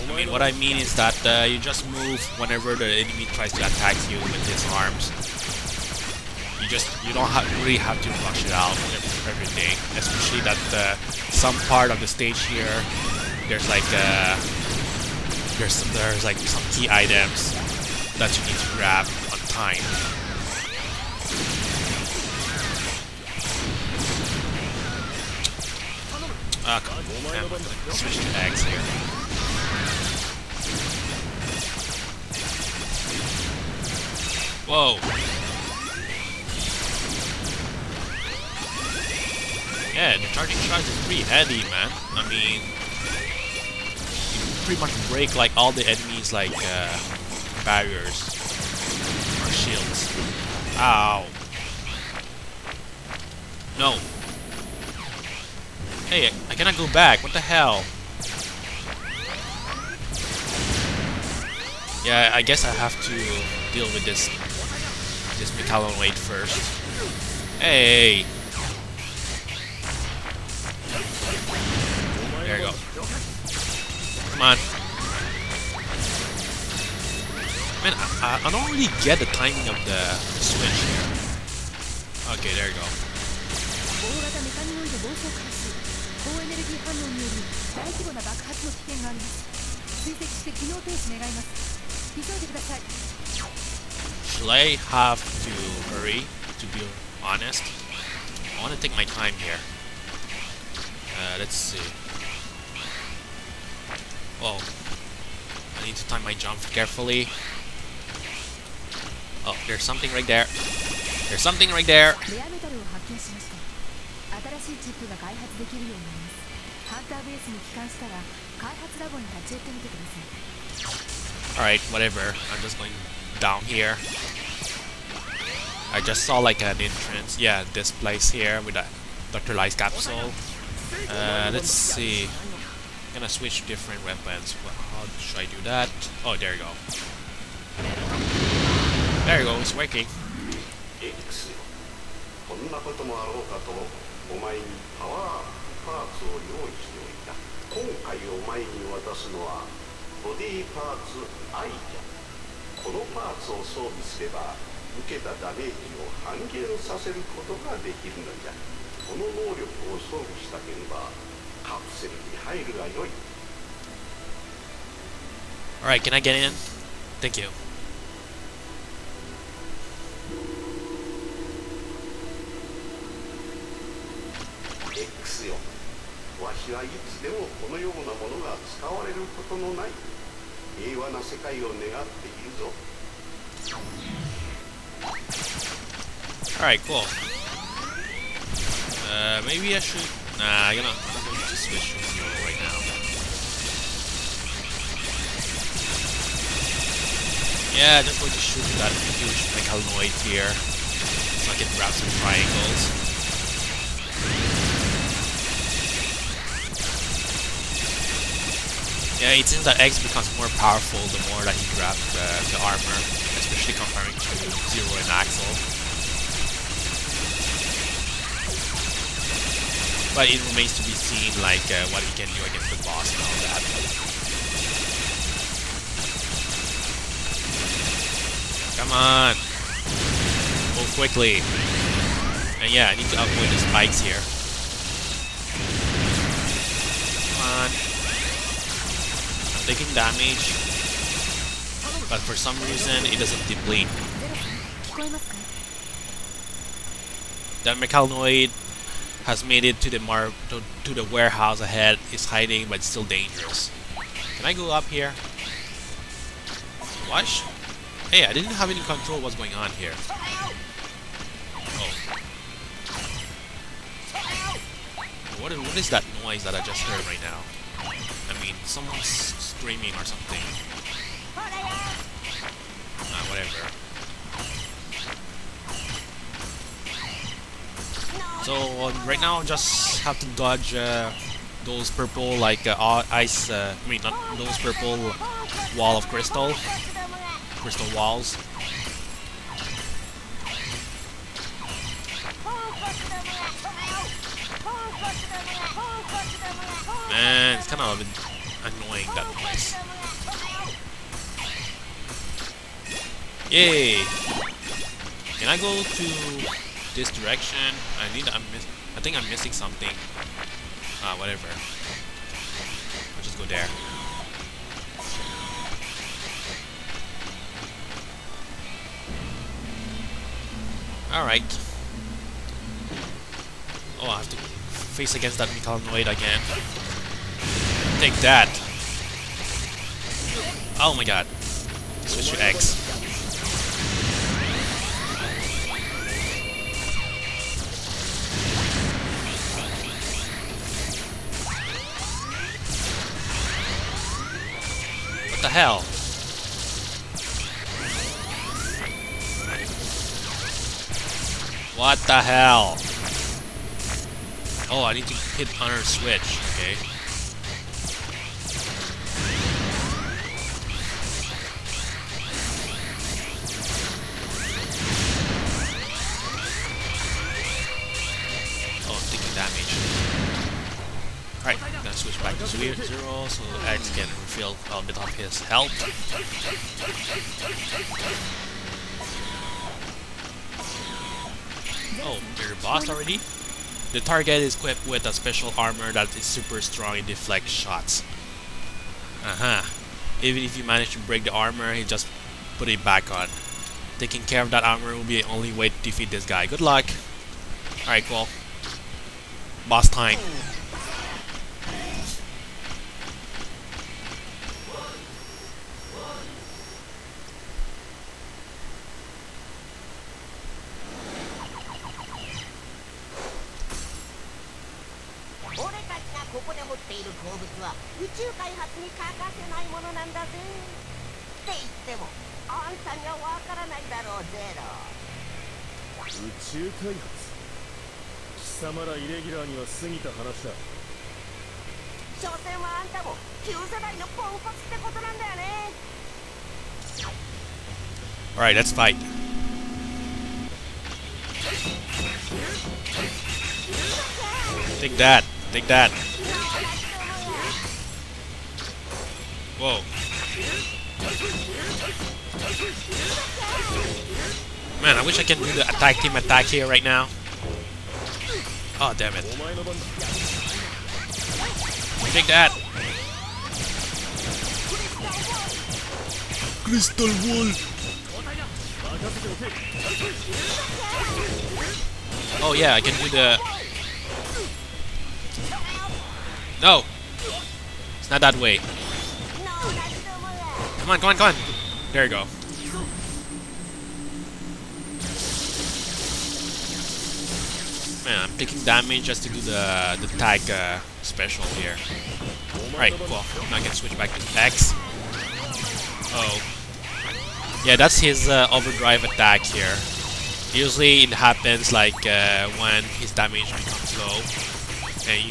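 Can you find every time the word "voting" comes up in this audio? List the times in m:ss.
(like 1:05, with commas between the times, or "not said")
not said.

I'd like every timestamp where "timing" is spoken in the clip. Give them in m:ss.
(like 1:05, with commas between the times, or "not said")
1:19.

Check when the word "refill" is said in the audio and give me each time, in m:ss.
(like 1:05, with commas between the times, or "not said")
6:14.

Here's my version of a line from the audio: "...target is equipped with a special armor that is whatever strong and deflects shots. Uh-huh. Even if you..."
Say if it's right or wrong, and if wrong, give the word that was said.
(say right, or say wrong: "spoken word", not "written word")
wrong: "super", not "whatever".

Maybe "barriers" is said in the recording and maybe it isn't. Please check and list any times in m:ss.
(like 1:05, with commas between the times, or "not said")
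0:47.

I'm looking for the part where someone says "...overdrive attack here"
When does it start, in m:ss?
8:18.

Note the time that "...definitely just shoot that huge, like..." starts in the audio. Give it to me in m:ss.
3:18.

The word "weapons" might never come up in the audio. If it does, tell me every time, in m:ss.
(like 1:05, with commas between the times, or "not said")
2:14.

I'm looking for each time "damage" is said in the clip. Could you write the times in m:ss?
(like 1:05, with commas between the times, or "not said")
3:59, 8:08, 8:23.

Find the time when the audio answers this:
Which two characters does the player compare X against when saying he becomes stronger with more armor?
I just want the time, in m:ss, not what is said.
3:34.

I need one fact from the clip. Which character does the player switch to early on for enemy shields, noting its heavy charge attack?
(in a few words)
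Axe.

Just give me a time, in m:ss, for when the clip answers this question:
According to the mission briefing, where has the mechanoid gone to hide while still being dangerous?
4:10.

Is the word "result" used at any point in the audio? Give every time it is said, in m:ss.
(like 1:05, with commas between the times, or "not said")
not said.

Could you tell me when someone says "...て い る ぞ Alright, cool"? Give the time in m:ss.
3:02.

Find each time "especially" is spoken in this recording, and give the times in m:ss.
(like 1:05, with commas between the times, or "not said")
0:09, 3:33.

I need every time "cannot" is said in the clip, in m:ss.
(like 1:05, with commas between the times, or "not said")
0:56.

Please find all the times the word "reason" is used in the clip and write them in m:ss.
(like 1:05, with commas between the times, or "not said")
4:02.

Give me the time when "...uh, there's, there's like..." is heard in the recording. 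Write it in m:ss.
0:13.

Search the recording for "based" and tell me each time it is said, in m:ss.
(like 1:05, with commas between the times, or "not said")
not said.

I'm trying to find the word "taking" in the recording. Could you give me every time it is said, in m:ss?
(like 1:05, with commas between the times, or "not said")
3:59, 6:33, 8:08.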